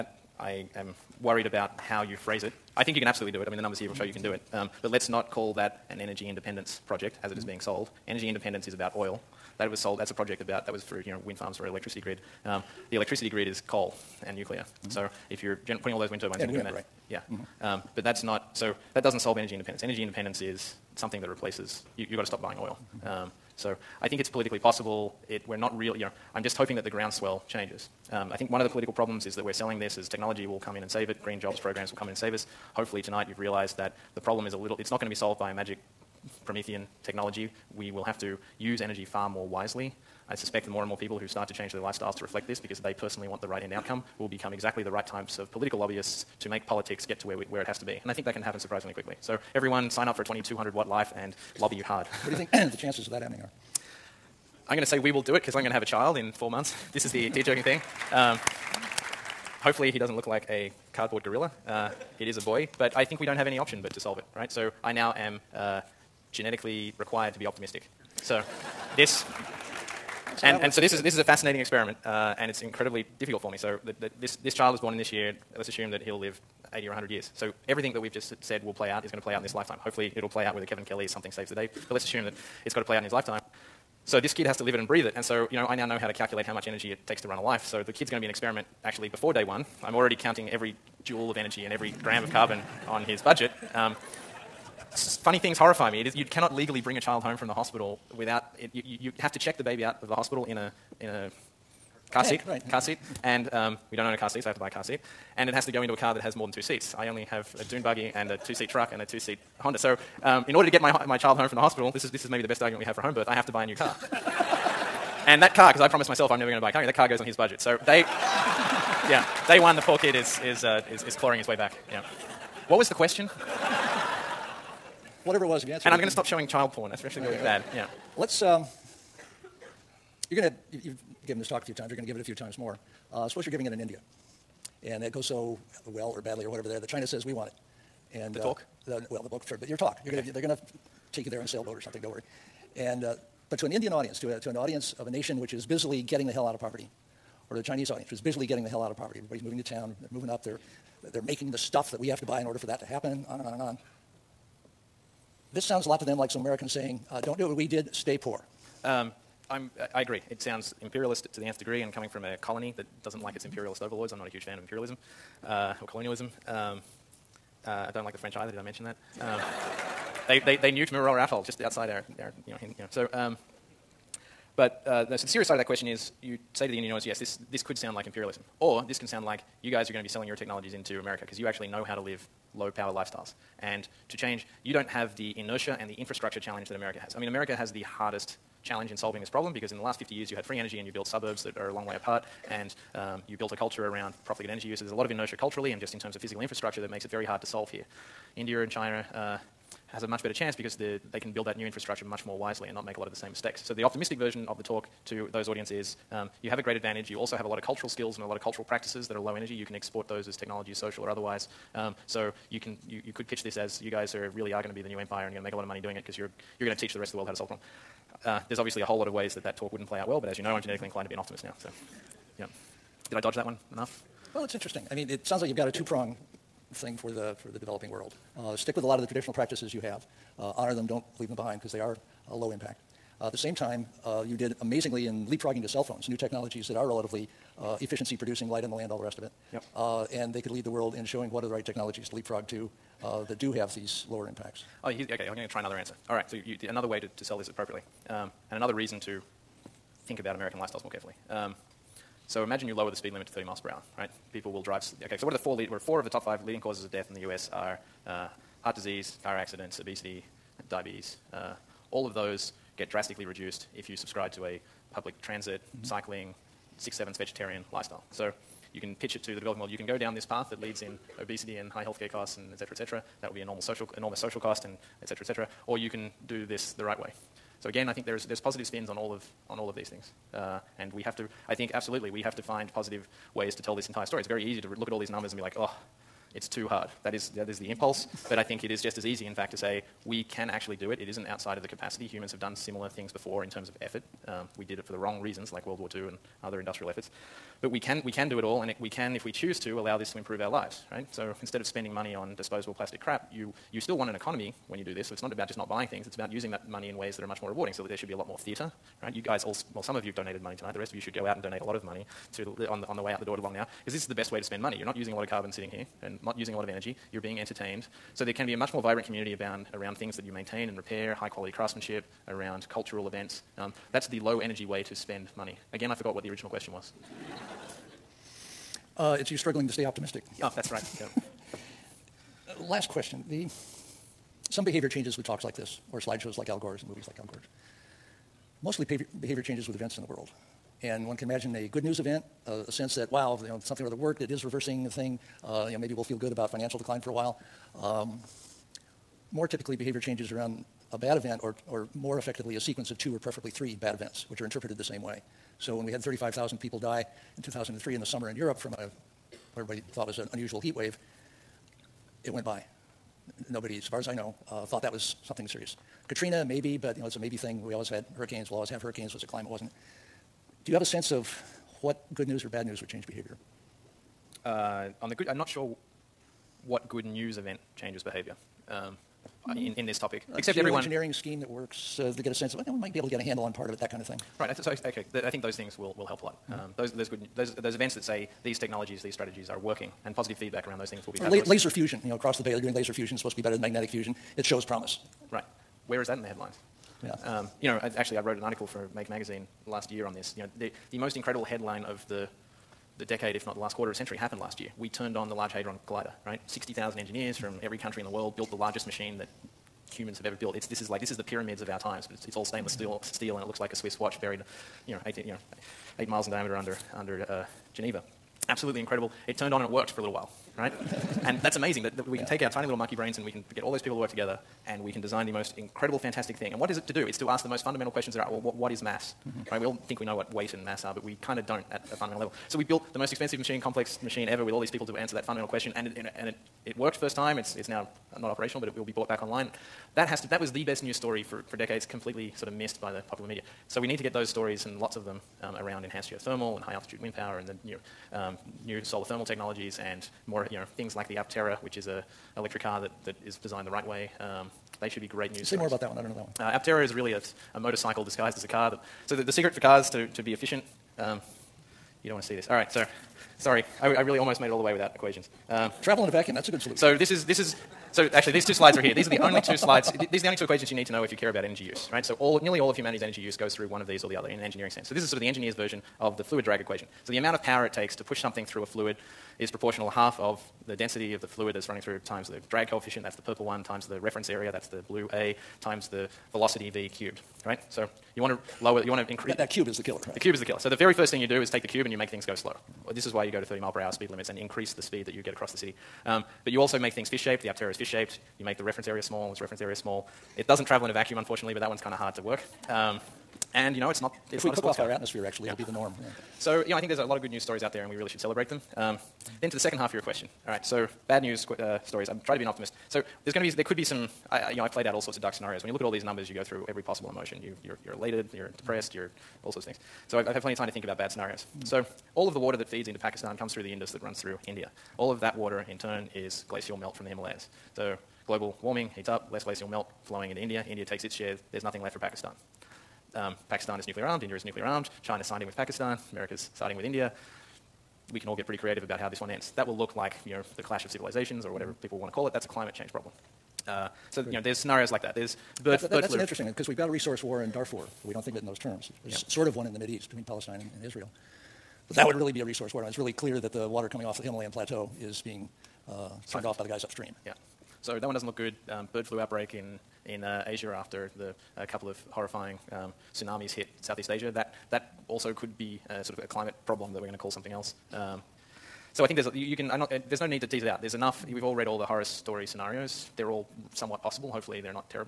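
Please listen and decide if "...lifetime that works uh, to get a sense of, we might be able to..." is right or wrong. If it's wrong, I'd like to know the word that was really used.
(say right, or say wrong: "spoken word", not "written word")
wrong: "scheme", not "lifetime".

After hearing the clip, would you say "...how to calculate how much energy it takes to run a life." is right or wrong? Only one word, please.
right.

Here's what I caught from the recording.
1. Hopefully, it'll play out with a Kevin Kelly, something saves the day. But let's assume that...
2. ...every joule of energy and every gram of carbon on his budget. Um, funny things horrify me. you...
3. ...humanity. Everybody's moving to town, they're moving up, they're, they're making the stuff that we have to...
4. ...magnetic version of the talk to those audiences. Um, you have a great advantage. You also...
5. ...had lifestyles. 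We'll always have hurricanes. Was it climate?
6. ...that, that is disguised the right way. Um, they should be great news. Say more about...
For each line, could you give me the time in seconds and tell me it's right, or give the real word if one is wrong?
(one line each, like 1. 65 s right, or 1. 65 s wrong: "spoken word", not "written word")
1. 79 s right
2. 90 s right
3. 148 s wrong: "poverty", not "humanity"
4. 203 s wrong: "optimistic", not "magnetic"
5. 367 s wrong: "hurricanes", not "lifestyles"
6. 452 s wrong: "designed", not "disguised".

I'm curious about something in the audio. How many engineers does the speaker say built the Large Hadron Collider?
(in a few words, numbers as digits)
60,000.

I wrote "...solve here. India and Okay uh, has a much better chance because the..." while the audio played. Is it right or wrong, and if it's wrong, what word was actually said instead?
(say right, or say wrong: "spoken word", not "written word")
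wrong: "China", not "Okay".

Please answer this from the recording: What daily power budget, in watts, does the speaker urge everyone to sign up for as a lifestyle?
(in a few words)
2200 watts.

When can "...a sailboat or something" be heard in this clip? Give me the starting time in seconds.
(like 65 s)
141 s.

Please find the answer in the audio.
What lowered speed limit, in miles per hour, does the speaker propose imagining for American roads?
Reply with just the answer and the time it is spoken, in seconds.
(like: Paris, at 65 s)
30 mph, at 253 s.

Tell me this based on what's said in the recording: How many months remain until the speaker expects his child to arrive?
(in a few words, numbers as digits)
4.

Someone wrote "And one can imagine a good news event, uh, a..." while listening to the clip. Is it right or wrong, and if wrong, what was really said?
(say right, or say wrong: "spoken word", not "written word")
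right.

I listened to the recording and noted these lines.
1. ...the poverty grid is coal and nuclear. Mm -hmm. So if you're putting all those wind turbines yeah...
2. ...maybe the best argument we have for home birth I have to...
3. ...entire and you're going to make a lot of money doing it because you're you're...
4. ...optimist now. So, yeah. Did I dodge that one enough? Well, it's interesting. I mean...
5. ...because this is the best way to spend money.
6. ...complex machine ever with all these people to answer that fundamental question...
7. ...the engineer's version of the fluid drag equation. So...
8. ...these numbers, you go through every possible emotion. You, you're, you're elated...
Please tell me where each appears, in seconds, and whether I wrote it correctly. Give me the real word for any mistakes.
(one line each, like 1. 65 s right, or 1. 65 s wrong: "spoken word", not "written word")
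1. 12 s wrong: "electricity", not "poverty"
2. 112 s right
3. 214 s wrong: "empire", not "entire"
4. 221 s right
5. 313 s right
6. 433 s right
7. 475 s right
8. 515 s right.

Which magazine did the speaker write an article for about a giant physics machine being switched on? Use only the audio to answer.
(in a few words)
Make Magazine.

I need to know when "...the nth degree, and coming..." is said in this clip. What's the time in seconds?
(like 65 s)
161 s.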